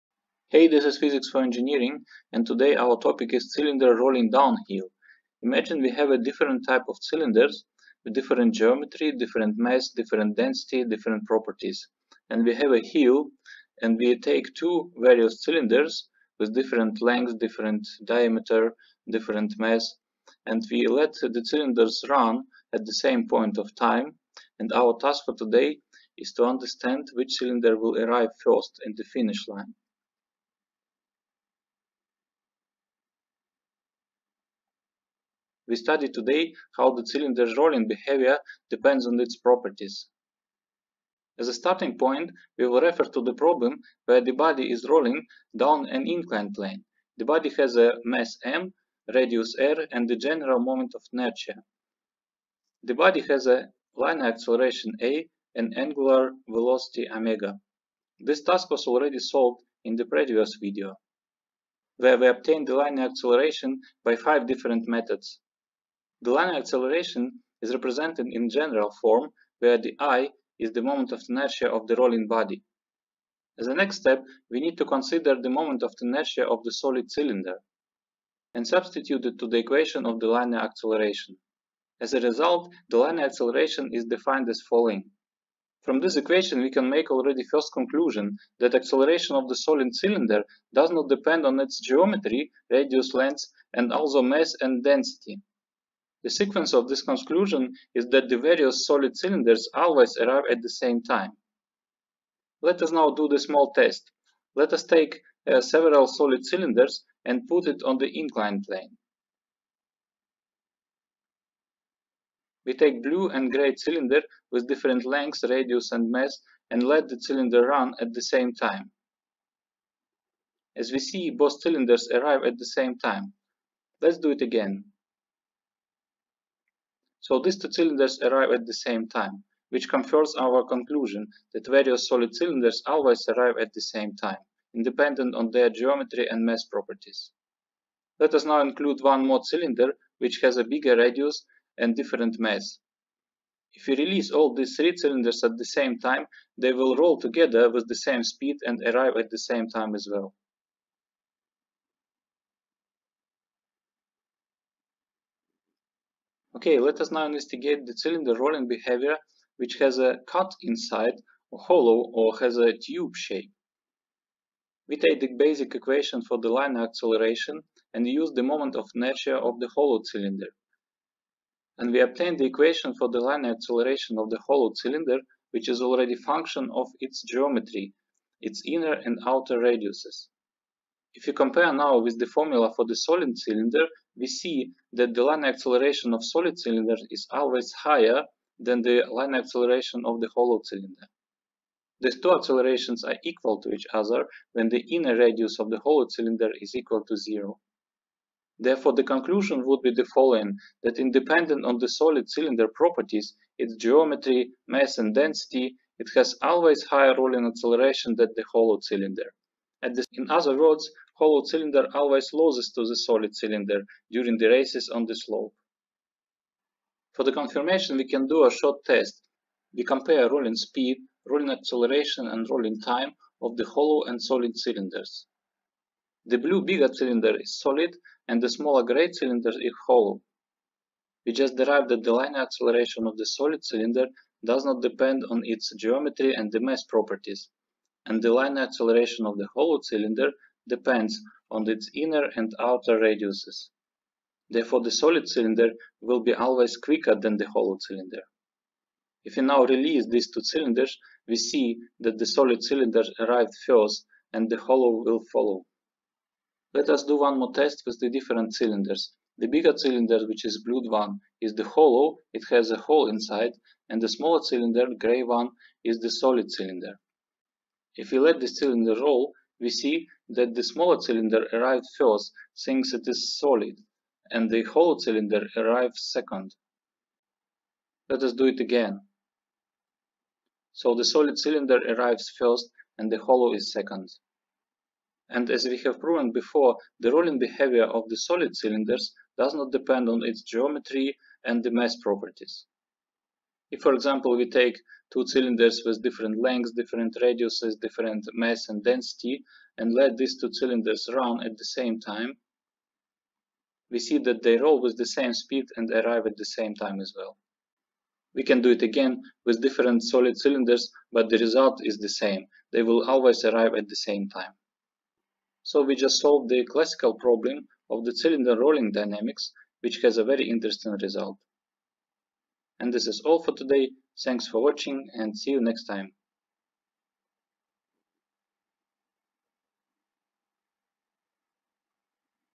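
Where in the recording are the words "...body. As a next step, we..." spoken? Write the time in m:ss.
1:12.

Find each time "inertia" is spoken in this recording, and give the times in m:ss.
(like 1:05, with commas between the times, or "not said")
0:51, 1:11, 1:15, 2:48.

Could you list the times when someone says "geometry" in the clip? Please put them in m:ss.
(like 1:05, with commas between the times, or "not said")
0:08, 1:31, 2:15, 2:57, 3:23, 3:55, 4:50.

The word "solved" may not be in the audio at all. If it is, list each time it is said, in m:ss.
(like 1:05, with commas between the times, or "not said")
0:59, 5:16.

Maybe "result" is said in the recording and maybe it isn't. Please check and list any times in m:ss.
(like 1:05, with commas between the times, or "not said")
1:22, 5:11, 5:21.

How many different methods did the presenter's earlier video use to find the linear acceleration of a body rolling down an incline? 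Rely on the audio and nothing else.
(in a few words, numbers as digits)
5.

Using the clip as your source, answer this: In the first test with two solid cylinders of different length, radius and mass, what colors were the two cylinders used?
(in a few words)
blue and grey.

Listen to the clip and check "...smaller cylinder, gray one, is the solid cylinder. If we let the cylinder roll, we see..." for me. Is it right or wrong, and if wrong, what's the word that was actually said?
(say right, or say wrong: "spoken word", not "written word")
right.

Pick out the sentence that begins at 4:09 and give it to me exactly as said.
If we now release these two cylinders, we see that the solid cylinder arrived first and the hollow will follow.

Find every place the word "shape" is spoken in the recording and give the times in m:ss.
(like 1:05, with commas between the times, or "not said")
2:43.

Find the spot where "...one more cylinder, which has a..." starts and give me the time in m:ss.
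2:19.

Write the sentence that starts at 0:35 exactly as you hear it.
We study today how the cylinder's rolling behavior depends on its properties.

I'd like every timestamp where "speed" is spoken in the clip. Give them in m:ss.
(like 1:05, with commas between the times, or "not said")
2:28, 3:40, 5:05.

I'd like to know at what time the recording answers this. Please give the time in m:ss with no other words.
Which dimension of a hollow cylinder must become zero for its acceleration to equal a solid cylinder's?
3:14.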